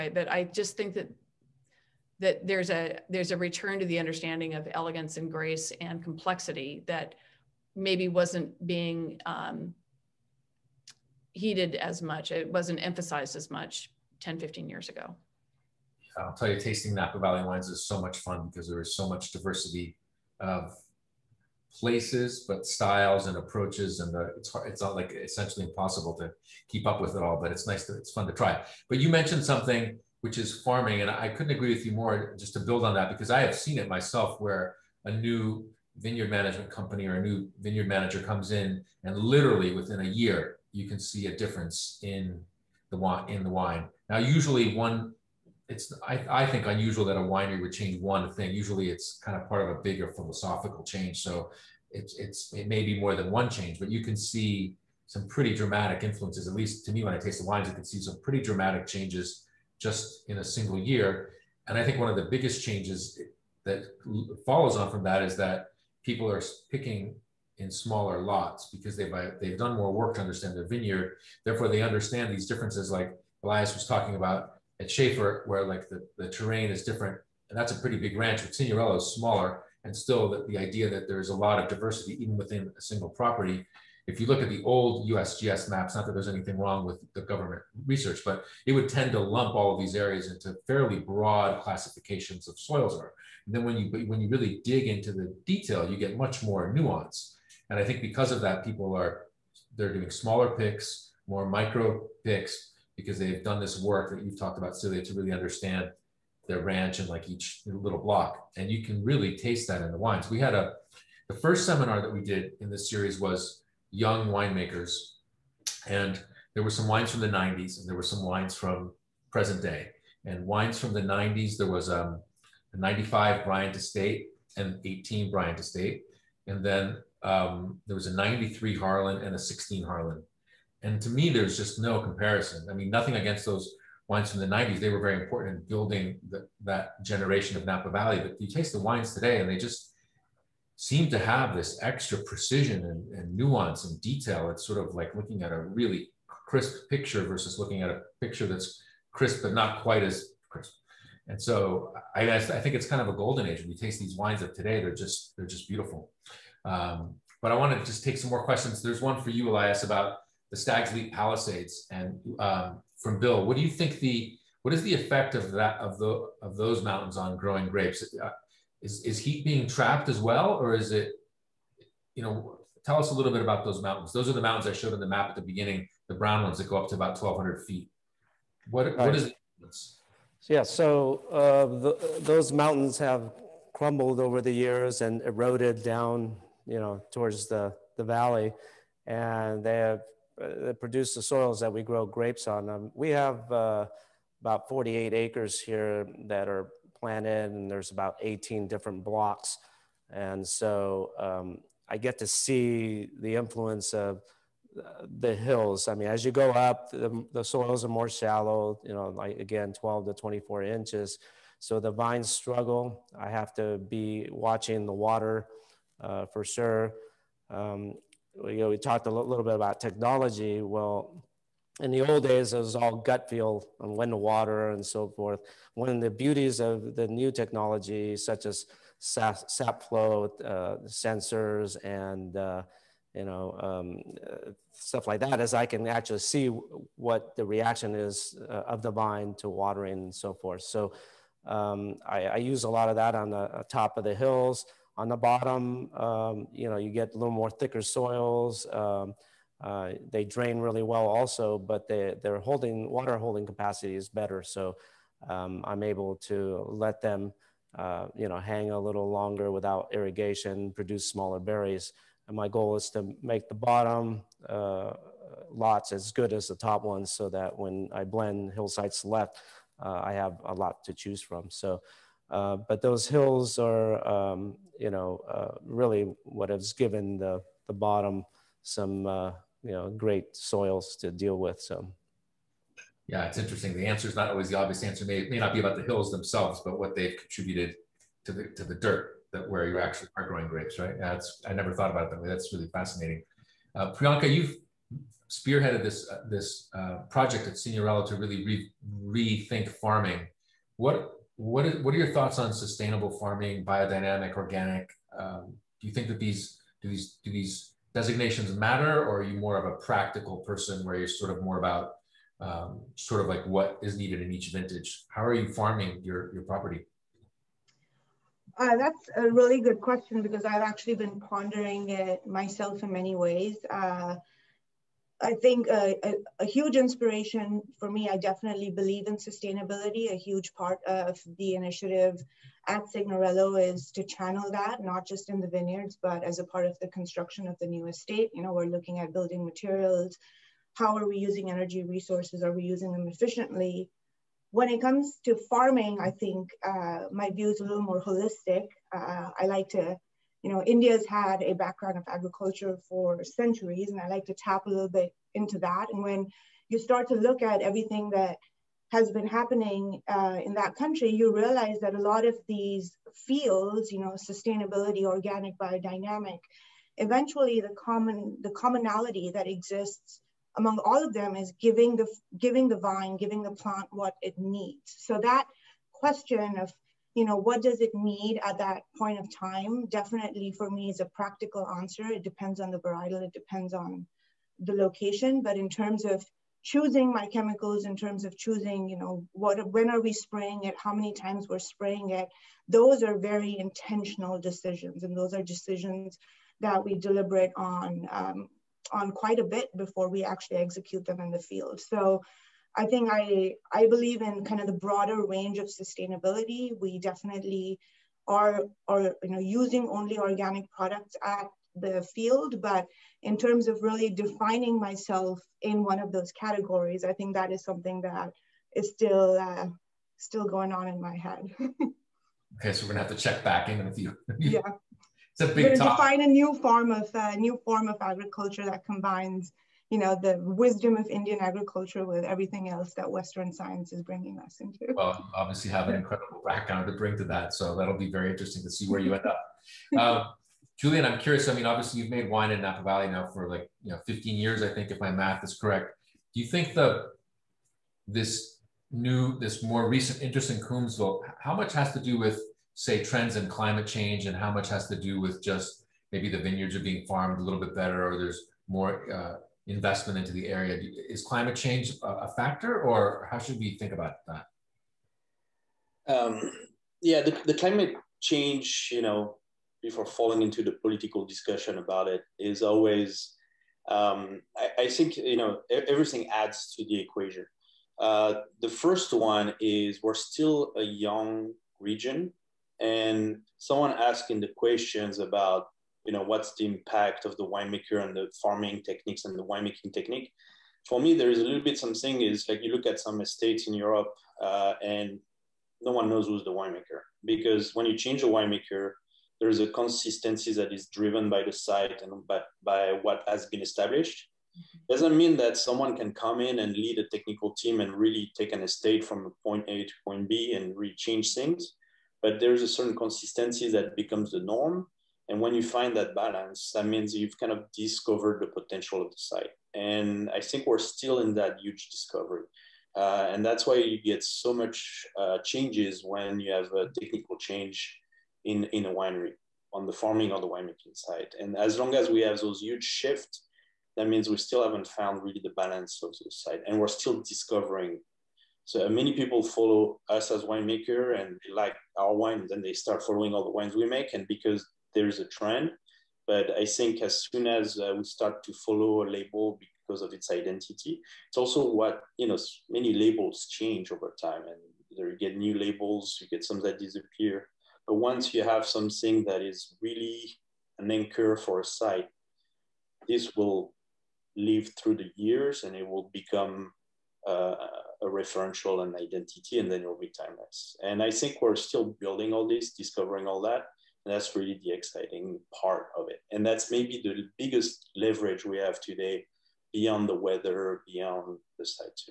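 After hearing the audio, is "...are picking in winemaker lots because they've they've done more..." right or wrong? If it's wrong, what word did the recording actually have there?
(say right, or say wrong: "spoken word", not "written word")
wrong: "smaller", not "winemaker".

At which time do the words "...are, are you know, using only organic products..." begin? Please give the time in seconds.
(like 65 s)
408 s.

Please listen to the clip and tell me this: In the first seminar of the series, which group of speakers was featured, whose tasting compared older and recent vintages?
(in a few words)
Young winemakers.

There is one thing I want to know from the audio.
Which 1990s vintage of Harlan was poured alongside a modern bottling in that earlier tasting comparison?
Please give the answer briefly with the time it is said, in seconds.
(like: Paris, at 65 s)
1993, at 128 s.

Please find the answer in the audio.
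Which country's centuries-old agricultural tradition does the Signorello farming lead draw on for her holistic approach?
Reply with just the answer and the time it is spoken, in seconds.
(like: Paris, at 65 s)
India, at 350 s.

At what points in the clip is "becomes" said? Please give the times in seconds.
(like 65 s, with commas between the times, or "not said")
513 s, 566 s.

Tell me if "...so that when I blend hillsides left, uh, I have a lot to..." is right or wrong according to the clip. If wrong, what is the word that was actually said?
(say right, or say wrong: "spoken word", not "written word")
right.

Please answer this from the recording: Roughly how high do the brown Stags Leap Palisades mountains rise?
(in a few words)
1,200 feet.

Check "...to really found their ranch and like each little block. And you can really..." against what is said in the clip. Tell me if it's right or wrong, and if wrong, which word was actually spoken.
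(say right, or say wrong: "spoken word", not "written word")
wrong: "understand", not "found".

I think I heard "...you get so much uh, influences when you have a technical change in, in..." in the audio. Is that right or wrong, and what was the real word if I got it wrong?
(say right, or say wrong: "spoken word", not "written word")
wrong: "changes", not "influences".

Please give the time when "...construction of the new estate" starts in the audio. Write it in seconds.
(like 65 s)
336 s.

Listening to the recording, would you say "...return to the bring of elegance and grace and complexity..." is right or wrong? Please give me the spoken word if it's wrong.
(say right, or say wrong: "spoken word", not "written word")
wrong: "understanding", not "bring".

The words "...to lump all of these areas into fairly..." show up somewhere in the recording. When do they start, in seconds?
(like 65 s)
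89 s.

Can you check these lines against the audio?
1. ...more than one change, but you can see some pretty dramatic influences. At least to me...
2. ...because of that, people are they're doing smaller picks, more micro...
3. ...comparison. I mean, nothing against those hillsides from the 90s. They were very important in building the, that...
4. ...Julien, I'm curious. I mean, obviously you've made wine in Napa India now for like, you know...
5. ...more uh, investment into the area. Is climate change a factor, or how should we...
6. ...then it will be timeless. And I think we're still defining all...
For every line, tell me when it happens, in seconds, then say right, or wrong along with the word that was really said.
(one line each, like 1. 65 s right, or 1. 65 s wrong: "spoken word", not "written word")
1. 52 s right
2. 98 s right
3. 131 s wrong: "wines", not "hillsides"
4. 440 s wrong: "Valley", not "India"
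5. 458 s right
6. 569 s wrong: "building", not "defining".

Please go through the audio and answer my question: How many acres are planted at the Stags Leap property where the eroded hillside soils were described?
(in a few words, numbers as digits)
48 acres.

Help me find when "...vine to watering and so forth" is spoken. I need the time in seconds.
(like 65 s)
238 s.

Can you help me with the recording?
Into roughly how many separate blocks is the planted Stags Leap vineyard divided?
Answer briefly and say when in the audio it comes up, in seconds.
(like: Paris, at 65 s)
18, at 198 s.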